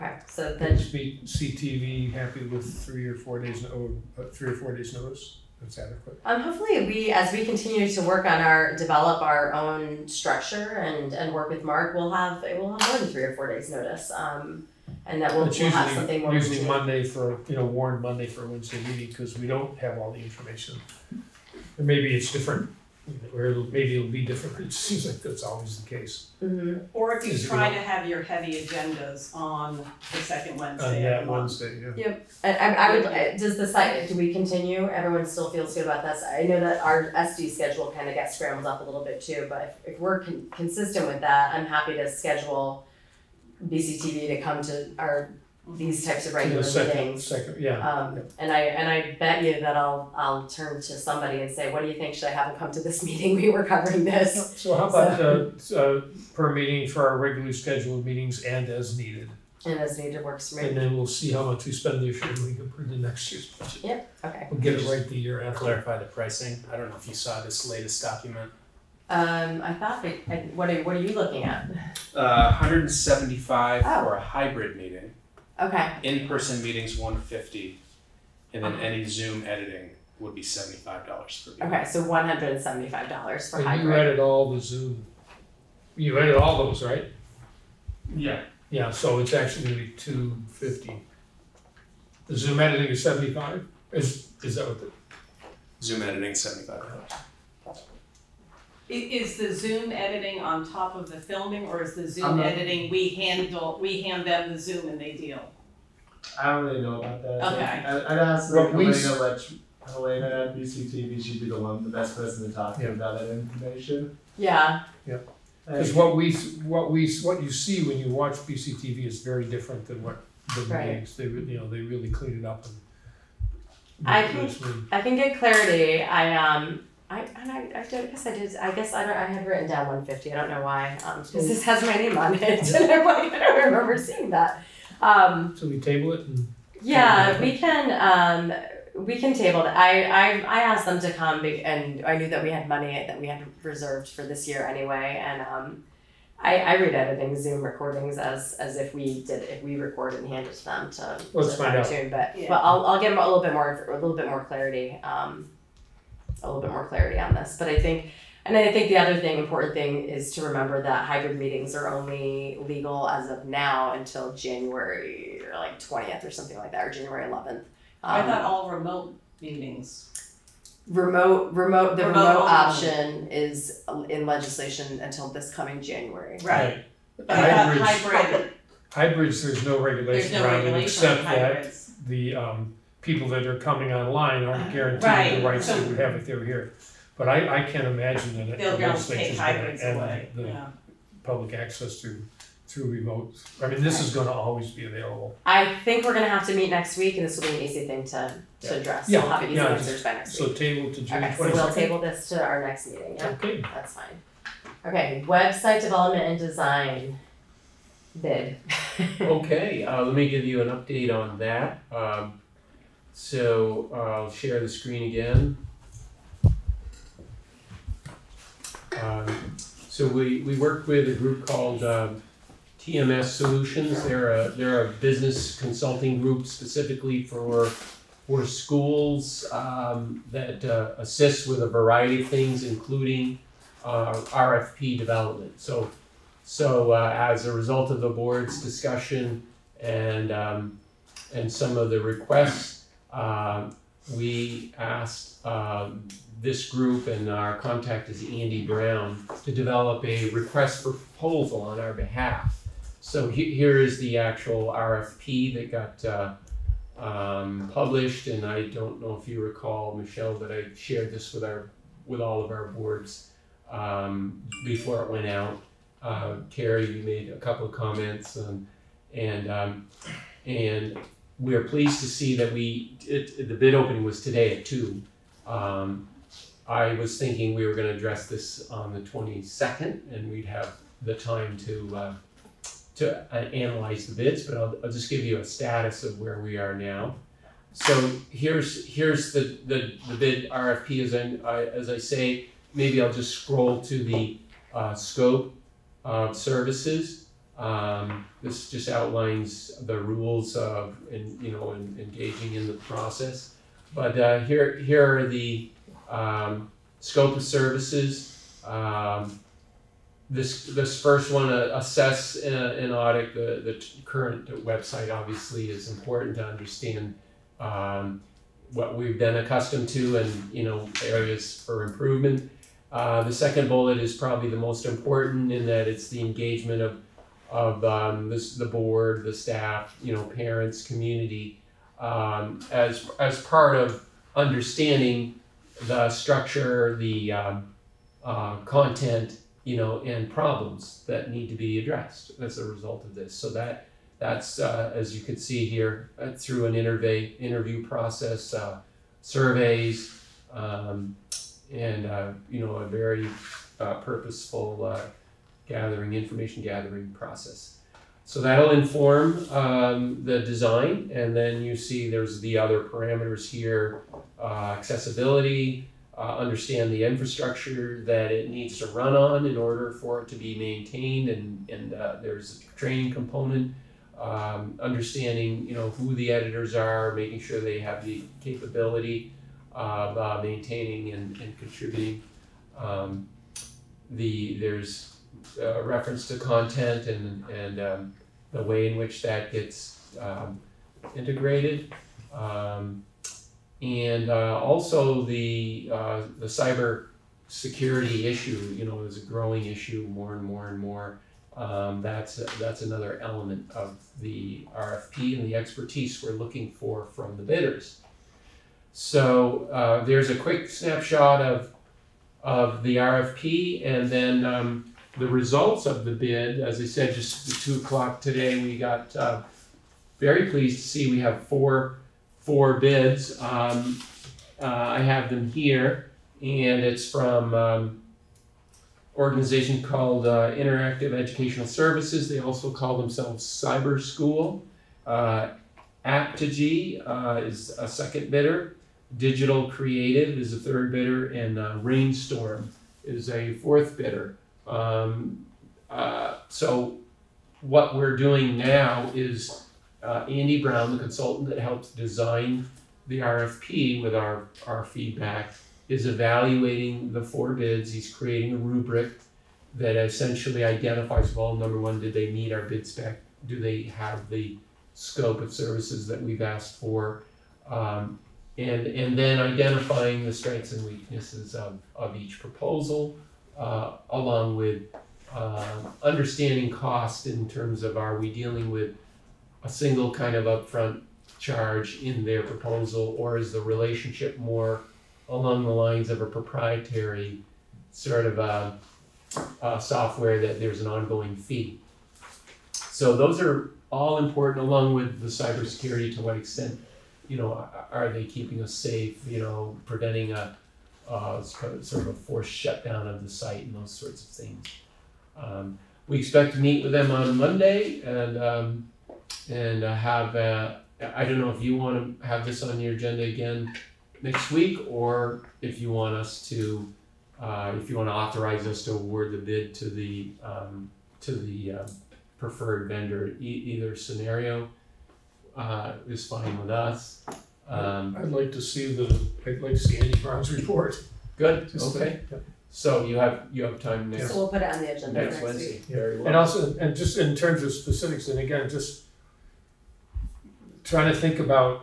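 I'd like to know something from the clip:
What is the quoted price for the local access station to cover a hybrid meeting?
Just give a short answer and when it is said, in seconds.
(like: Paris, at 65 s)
$175, at 72 s.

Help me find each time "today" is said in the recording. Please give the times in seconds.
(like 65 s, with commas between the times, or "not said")
274 s, 418 s.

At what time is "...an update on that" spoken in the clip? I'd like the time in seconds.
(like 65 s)
210 s.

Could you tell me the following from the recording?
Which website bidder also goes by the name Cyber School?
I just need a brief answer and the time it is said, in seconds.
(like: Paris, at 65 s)
Interactive Educational Services, at 430 s.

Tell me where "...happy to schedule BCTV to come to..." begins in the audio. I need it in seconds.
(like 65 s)
41 s.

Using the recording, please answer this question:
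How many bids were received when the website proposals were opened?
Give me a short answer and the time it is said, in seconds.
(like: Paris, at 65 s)
4, at 421 s.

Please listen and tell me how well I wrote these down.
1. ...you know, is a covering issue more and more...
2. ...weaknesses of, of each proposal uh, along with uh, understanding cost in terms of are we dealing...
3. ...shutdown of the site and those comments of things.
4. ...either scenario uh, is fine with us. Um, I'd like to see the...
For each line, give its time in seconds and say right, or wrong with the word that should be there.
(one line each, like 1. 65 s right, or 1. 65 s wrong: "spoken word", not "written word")
1. 398 s wrong: "growing", not "covering"
2. 470 s right
3. 502 s wrong: "sorts", not "comments"
4. 523 s right.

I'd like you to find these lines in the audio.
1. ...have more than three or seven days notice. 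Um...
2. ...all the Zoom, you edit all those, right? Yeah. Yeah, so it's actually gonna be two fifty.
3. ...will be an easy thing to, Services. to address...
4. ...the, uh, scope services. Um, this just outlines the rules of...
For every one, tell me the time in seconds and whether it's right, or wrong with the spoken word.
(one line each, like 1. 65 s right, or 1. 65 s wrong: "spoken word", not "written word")
1. 12 s wrong: "four", not "seven"
2. 84 s right
3. 197 s wrong: "Yeah", not "Services"
4. 294 s right.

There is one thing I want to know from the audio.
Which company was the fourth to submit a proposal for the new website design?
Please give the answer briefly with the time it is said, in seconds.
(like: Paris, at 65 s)
Rainstorm, at 441 s.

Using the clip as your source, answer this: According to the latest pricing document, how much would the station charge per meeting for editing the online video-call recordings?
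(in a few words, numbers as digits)
$75.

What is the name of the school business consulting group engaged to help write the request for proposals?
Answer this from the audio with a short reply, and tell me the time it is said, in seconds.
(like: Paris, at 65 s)
TMS Solutions, at 222 s.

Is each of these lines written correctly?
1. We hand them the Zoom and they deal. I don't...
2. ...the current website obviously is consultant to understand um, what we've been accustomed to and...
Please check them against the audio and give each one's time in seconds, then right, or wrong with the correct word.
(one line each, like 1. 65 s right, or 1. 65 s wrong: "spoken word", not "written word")
1. 103 s right
2. 313 s wrong: "important", not "consultant".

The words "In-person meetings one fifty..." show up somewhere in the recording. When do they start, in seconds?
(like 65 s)
76 s.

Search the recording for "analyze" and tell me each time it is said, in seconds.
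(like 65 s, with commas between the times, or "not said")
283 s.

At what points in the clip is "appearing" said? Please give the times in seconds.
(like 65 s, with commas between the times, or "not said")
not said.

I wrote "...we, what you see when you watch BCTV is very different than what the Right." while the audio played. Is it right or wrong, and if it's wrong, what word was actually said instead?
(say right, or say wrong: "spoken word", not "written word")
right.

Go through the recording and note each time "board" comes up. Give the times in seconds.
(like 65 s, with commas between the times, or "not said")
238 s, 262 s, 328 s.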